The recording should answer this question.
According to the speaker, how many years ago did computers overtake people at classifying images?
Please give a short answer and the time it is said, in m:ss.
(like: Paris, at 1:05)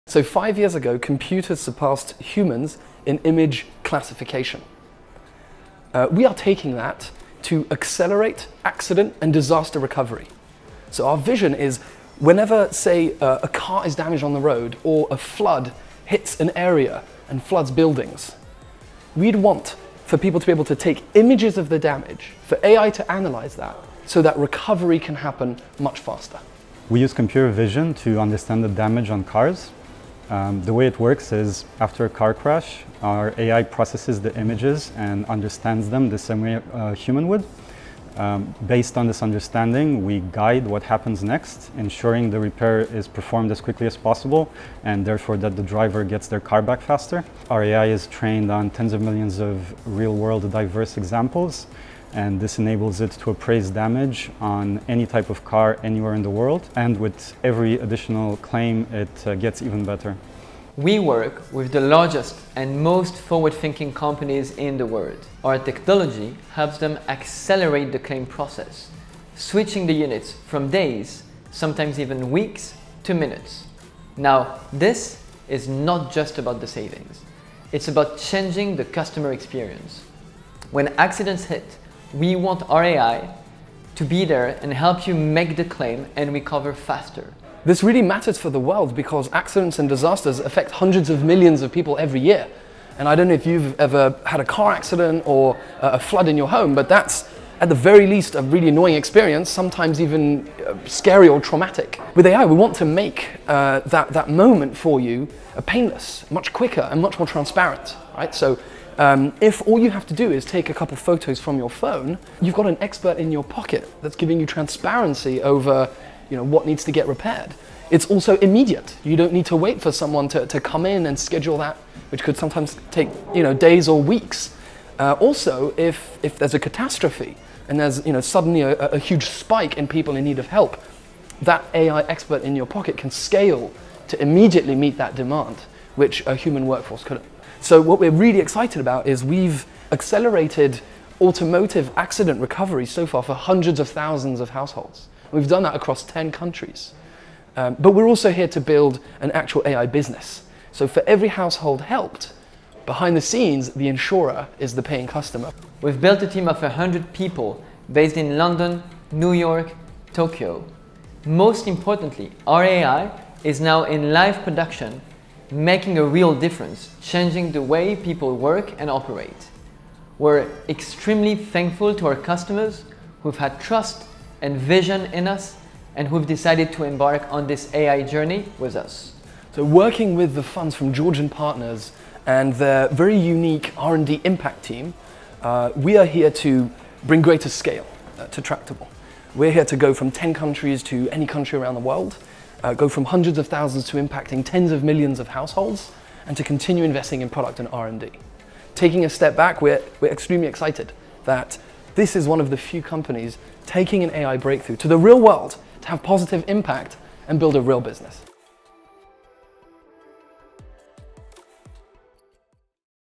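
5, at 0:00.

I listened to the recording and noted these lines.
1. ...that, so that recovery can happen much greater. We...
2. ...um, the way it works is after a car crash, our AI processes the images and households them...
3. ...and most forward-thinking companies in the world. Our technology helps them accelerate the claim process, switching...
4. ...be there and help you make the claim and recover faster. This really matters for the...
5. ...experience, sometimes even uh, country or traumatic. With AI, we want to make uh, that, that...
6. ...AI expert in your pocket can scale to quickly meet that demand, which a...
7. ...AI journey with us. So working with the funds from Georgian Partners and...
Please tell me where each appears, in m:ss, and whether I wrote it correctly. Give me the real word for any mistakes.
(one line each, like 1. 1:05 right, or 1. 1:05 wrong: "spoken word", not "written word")
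1. 0:23 wrong: "faster", not "greater"
2. 0:30 wrong: "understands", not "households"
3. 1:02 right
4. 1:24 right
5. 1:38 wrong: "scary", not "country"
6. 2:11 wrong: "immediately", not "quickly"
7. 2:57 right.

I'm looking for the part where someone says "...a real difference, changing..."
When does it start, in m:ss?
2:45.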